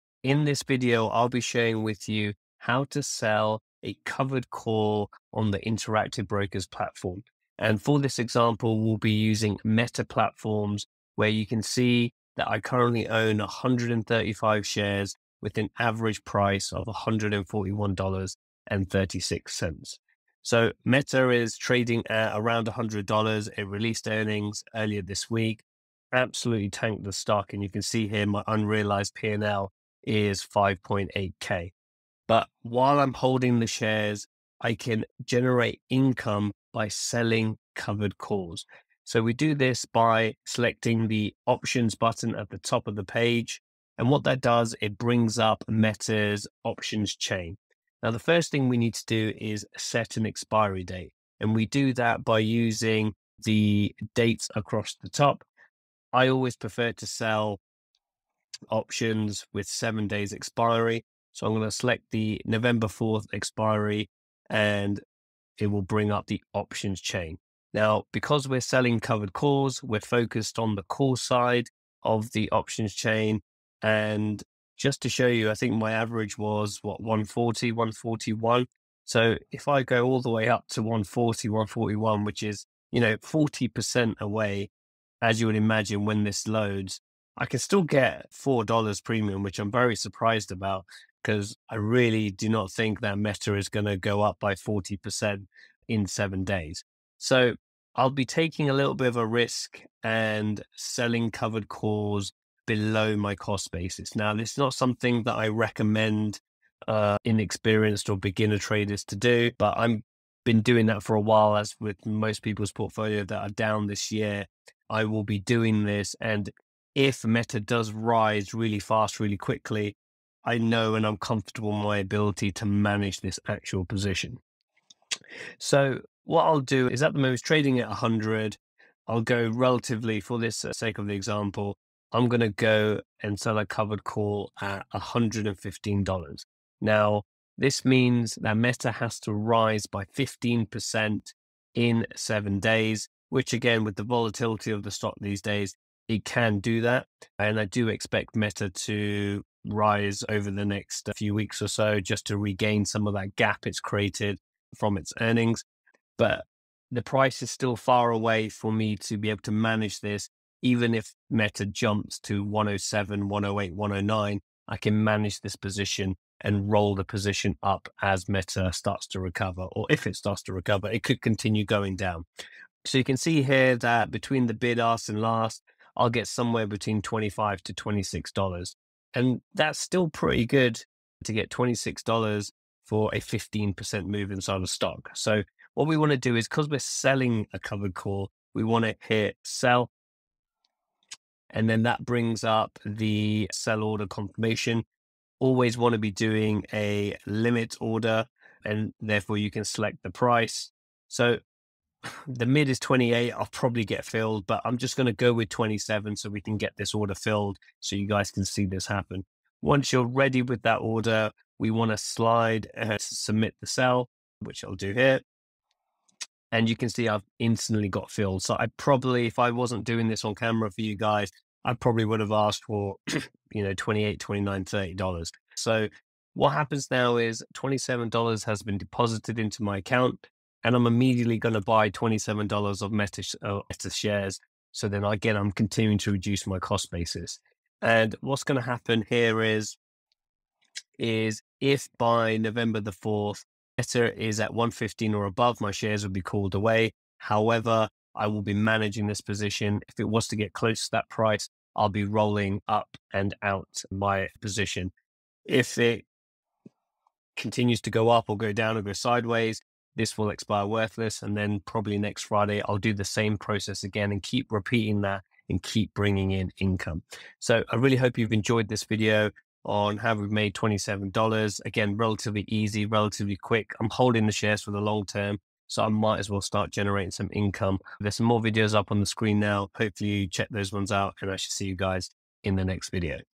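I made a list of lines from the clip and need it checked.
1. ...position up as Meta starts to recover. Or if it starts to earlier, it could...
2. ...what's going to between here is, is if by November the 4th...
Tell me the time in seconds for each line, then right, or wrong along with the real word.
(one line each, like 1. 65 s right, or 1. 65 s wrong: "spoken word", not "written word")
1. 167 s wrong: "recover", not "earlier"
2. 238 s wrong: "happen", not "between".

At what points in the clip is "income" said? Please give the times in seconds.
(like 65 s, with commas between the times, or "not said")
35 s, 266 s, 277 s.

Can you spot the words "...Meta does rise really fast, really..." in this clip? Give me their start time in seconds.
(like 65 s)
117 s.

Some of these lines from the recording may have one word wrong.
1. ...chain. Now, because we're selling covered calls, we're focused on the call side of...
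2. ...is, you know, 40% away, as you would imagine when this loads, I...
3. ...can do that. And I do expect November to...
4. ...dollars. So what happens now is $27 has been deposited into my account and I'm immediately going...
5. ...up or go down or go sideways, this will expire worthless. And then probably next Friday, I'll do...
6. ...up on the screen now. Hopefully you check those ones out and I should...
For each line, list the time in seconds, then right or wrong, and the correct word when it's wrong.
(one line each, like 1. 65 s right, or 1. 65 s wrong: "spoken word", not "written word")
1. 66 s right
2. 82 s right
3. 146 s wrong: "Meta", not "November"
4. 224 s right
5. 258 s right
6. 278 s right.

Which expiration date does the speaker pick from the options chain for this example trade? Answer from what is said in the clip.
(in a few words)
November 4th.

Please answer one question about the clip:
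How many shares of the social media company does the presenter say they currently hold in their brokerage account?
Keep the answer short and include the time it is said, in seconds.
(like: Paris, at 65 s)
135, at 13 s.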